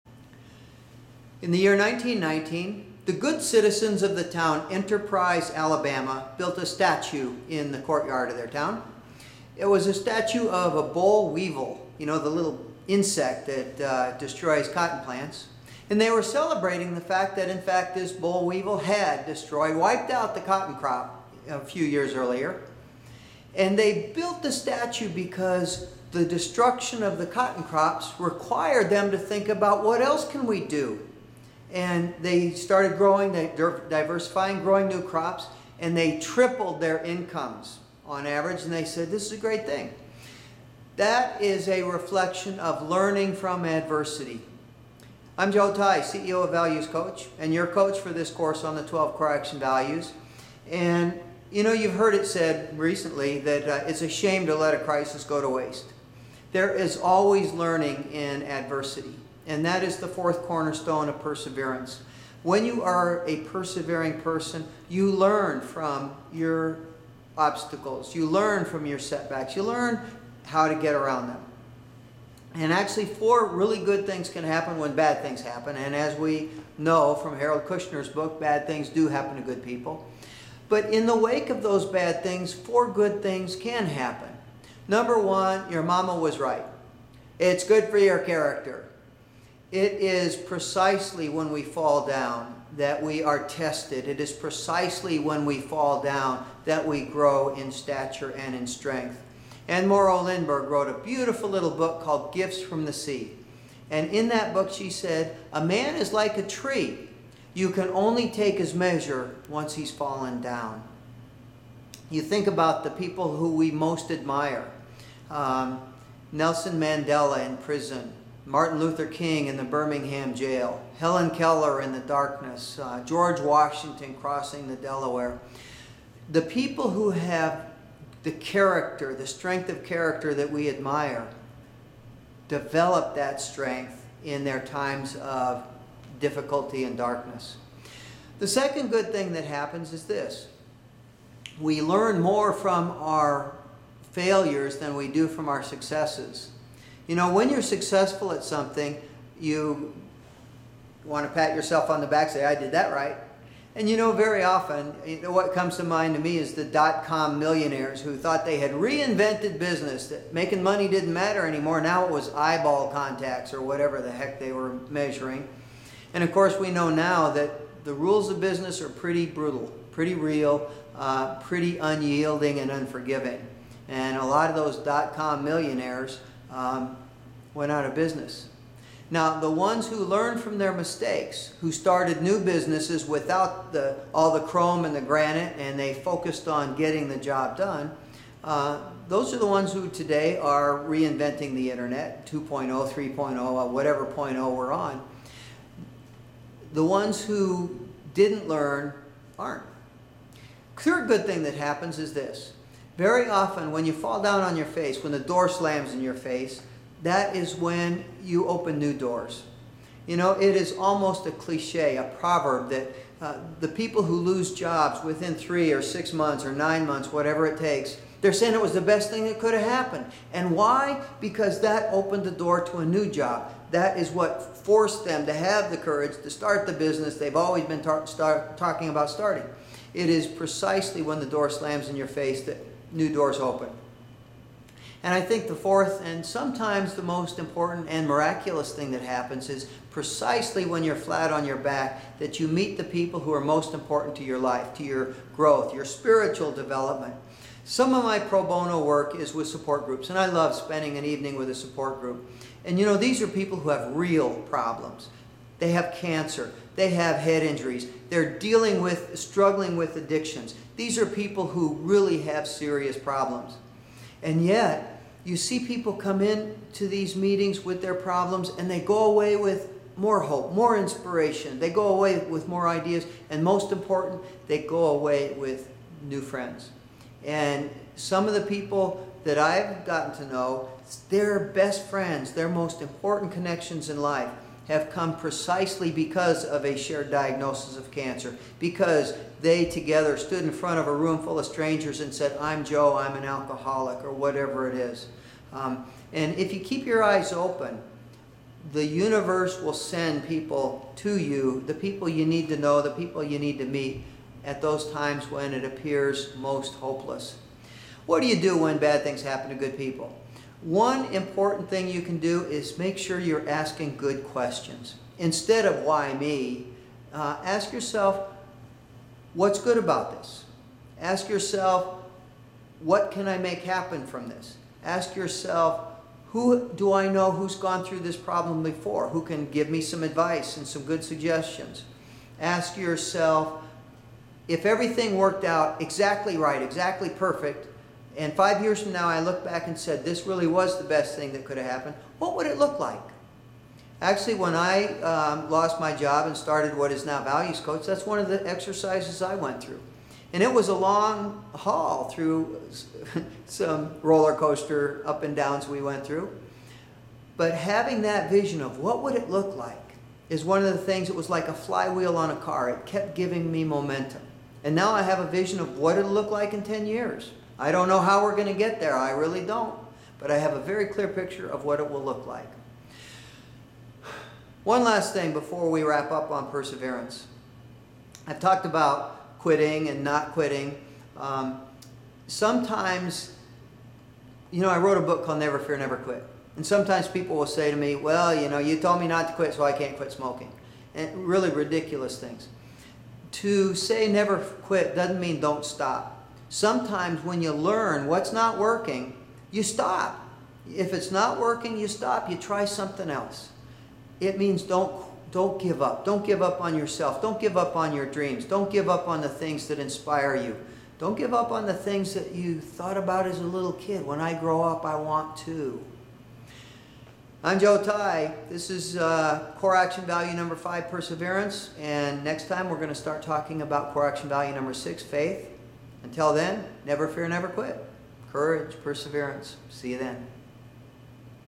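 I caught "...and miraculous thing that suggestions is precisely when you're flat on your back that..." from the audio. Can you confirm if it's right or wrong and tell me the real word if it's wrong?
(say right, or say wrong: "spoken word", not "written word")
wrong: "happens", not "suggestions".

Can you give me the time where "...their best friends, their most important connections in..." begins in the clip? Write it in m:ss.
4:41.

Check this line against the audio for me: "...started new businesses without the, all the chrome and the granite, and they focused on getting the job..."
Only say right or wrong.
right.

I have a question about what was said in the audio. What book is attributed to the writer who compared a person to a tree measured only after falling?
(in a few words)
Gifts from the Sea.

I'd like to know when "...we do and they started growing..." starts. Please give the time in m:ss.
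0:30.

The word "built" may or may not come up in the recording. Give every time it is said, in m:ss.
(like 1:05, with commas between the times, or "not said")
0:06, 0:24.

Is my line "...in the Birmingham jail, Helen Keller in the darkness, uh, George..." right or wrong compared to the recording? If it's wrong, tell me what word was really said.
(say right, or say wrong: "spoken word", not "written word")
right.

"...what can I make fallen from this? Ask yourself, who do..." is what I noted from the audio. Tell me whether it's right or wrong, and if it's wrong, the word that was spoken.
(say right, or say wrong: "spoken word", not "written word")
wrong: "happen", not "fallen".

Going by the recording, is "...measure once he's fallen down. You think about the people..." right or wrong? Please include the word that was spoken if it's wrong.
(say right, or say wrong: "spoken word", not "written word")
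right.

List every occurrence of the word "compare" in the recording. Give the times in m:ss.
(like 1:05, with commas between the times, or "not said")
not said.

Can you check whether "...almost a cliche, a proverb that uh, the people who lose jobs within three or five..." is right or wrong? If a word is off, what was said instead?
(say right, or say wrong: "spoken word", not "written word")
wrong: "six", not "five".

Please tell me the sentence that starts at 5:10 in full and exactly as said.
One important thing you can do is make sure you're asking good questions.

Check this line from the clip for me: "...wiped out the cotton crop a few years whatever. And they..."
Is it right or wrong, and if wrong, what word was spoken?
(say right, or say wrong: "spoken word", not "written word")
wrong: "earlier", not "whatever".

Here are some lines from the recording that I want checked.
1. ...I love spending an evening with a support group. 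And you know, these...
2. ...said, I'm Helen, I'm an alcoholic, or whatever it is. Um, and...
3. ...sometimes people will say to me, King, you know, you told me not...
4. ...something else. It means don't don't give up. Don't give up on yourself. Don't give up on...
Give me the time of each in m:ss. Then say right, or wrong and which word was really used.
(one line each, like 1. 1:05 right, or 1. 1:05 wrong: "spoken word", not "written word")
1. 4:10 right
2. 4:52 wrong: "Joe", not "Helen"
3. 6:26 wrong: "Well", not "King"
4. 6:42 right.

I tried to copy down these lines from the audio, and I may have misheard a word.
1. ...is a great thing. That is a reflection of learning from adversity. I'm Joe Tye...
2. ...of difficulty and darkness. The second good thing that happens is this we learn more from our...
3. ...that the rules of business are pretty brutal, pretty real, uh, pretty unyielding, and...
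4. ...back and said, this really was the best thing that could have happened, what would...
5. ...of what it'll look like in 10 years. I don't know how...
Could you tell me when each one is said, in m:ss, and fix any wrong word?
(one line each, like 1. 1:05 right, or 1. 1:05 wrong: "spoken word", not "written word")
1. 0:39 right
2. 2:15 right
3. 2:47 right
4. 5:39 right
5. 6:05 right.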